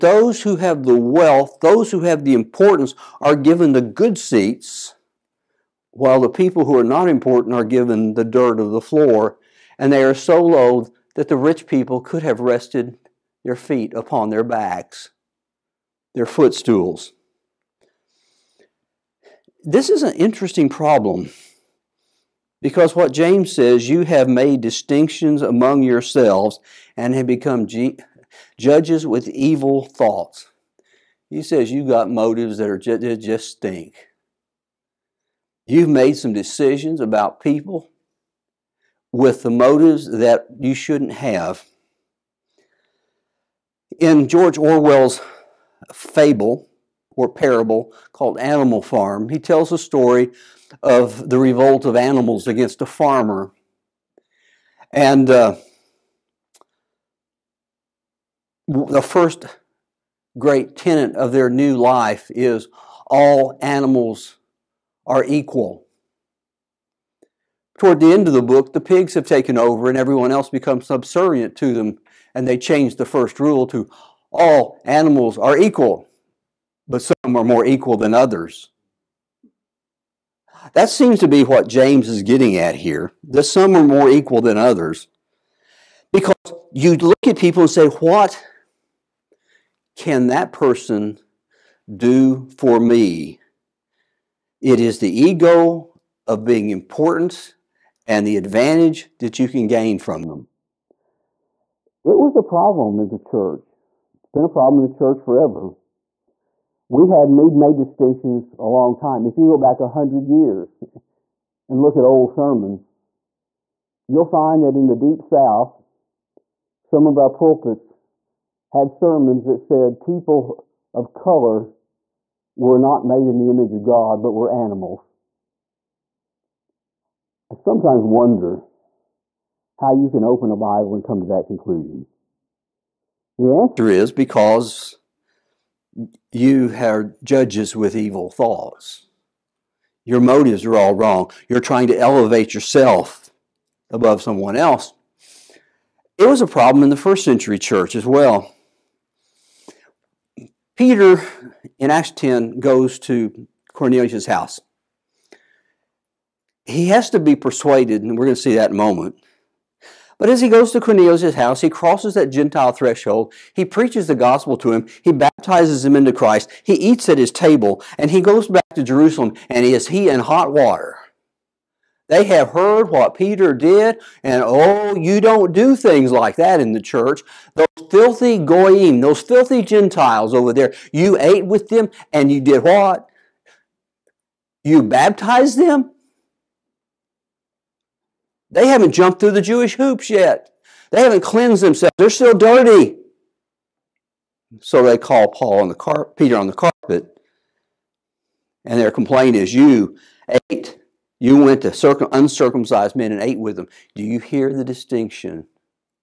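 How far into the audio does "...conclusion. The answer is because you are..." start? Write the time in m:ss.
2:11.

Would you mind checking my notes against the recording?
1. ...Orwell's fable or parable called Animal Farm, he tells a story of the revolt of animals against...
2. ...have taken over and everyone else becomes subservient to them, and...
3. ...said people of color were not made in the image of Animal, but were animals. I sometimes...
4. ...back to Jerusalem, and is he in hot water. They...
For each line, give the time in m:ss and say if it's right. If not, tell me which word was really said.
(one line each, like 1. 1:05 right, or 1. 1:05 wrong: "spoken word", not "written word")
1. 0:44 right
2. 1:09 right
3. 1:59 wrong: "God", not "Animal"
4. 2:48 right.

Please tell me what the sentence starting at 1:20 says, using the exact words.
That seems to be what James is getting at here, that some are more equal than others.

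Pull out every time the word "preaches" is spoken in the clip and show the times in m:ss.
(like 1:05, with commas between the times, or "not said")
2:43.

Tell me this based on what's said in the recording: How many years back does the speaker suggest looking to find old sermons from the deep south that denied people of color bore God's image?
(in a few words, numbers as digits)
100.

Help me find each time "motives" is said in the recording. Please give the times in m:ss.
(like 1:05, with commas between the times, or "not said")
0:32, 0:39, 2:20.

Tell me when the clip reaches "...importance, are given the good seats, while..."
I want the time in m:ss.
0:02.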